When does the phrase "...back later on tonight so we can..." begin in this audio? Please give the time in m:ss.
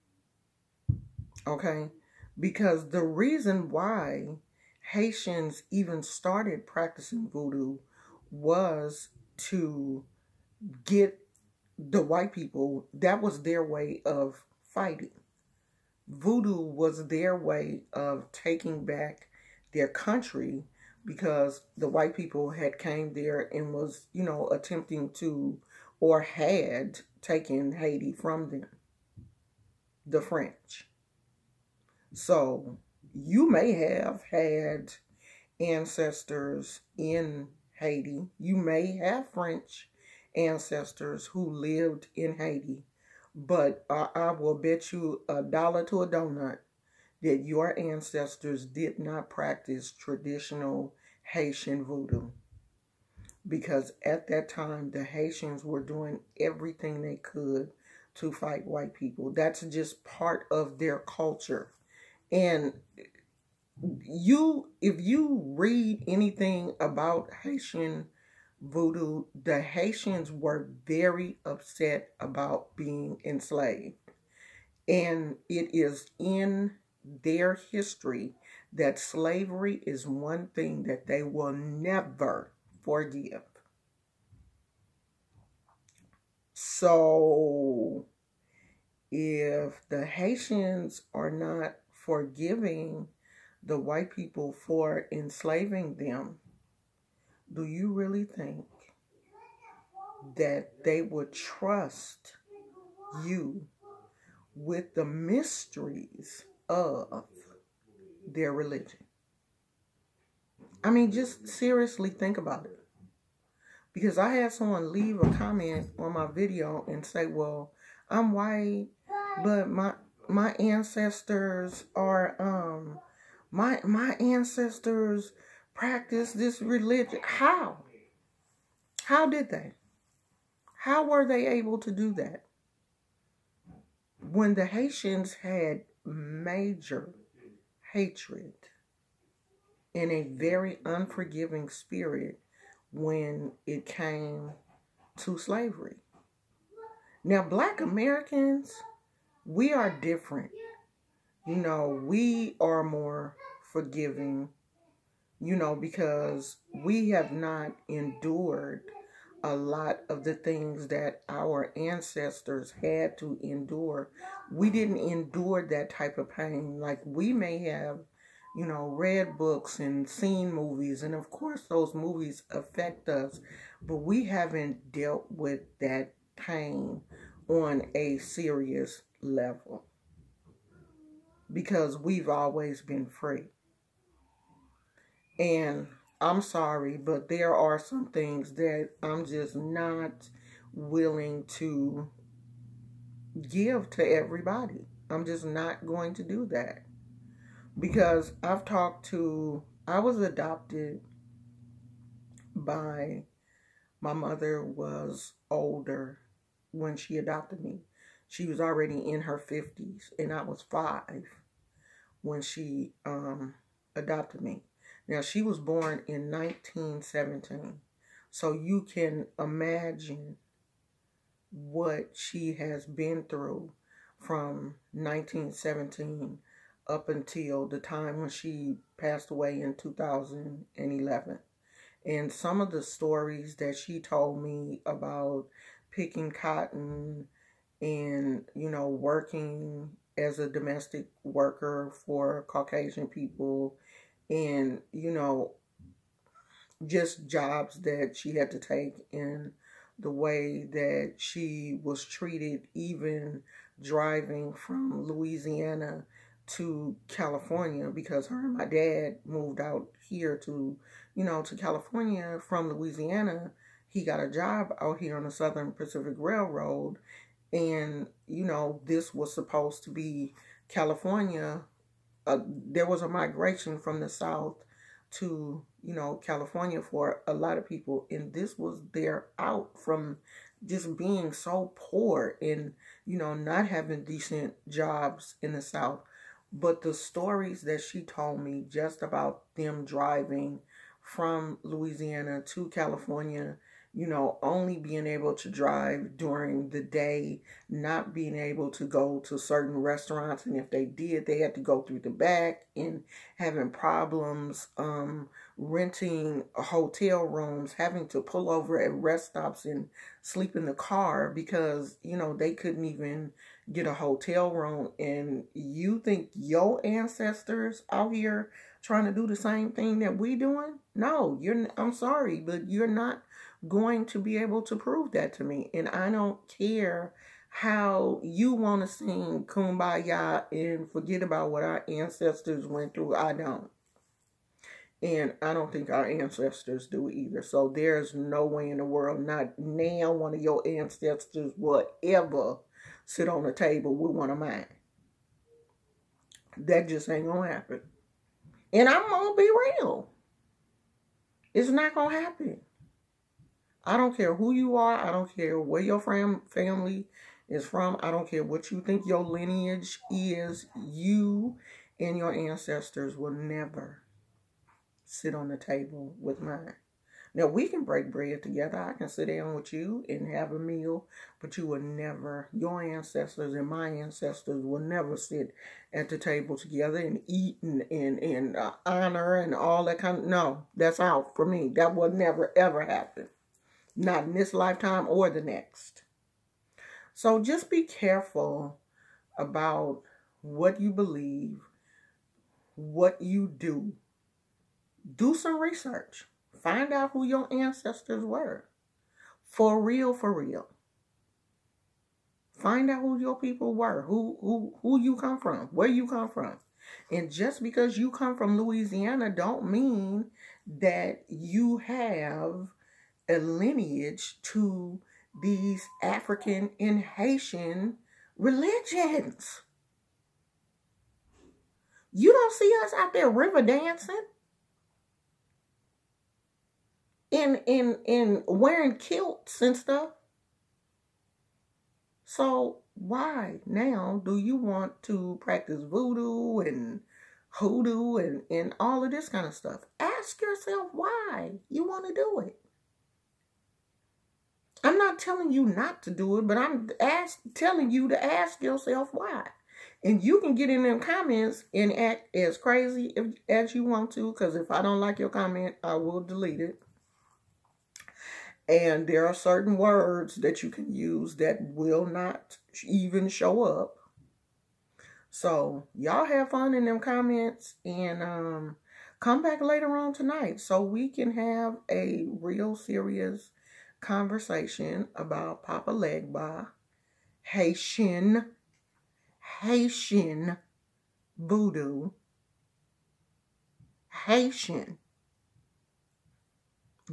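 7:49.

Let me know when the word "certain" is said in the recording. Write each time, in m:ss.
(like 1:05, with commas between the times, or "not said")
4:59, 7:39.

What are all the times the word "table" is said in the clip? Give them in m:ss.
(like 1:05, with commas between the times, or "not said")
5:43, 6:05, 6:16.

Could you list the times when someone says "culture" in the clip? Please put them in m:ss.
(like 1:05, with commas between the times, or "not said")
1:00.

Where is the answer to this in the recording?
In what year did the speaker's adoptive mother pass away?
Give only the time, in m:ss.
3:49.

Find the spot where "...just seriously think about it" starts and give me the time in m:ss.
1:51.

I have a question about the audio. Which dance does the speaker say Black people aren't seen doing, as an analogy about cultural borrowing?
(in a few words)
River dancing.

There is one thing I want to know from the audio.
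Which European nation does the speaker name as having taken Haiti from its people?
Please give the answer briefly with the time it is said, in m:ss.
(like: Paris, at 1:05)
The French, at 0:30.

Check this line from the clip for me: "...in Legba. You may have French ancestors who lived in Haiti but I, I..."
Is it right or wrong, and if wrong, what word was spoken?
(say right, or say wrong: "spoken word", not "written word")
wrong: "Haiti", not "Legba".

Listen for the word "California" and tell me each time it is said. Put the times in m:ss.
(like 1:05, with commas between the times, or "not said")
4:17, 4:21, 4:30, 4:36, 4:52.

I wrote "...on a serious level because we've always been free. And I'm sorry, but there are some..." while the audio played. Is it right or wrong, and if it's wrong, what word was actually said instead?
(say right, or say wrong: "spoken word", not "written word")
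right.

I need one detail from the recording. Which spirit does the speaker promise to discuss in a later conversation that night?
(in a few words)
Papa Legba.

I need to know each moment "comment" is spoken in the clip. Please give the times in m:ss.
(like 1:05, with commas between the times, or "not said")
1:55, 7:30, 7:35, 7:46.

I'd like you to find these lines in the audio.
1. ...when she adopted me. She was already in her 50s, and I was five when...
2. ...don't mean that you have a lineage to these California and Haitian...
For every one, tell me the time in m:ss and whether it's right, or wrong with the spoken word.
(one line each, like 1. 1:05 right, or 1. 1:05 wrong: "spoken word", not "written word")
1. 3:26 right
2. 6:49 wrong: "African", not "California".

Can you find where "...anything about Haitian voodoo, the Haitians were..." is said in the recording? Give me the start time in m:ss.
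1:06.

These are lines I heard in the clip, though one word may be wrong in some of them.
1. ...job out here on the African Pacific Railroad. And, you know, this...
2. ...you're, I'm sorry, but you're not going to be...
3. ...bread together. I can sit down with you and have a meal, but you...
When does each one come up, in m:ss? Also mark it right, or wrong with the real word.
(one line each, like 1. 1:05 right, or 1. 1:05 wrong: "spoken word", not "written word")
1. 4:24 wrong: "Southern", not "African"
2. 5:21 right
3. 6:08 right.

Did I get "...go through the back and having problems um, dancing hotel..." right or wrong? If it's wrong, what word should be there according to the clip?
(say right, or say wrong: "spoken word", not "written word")
wrong: "renting", not "dancing".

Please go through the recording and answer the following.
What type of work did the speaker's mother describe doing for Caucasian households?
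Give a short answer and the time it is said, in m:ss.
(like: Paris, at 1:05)
Domestic worker, at 4:00.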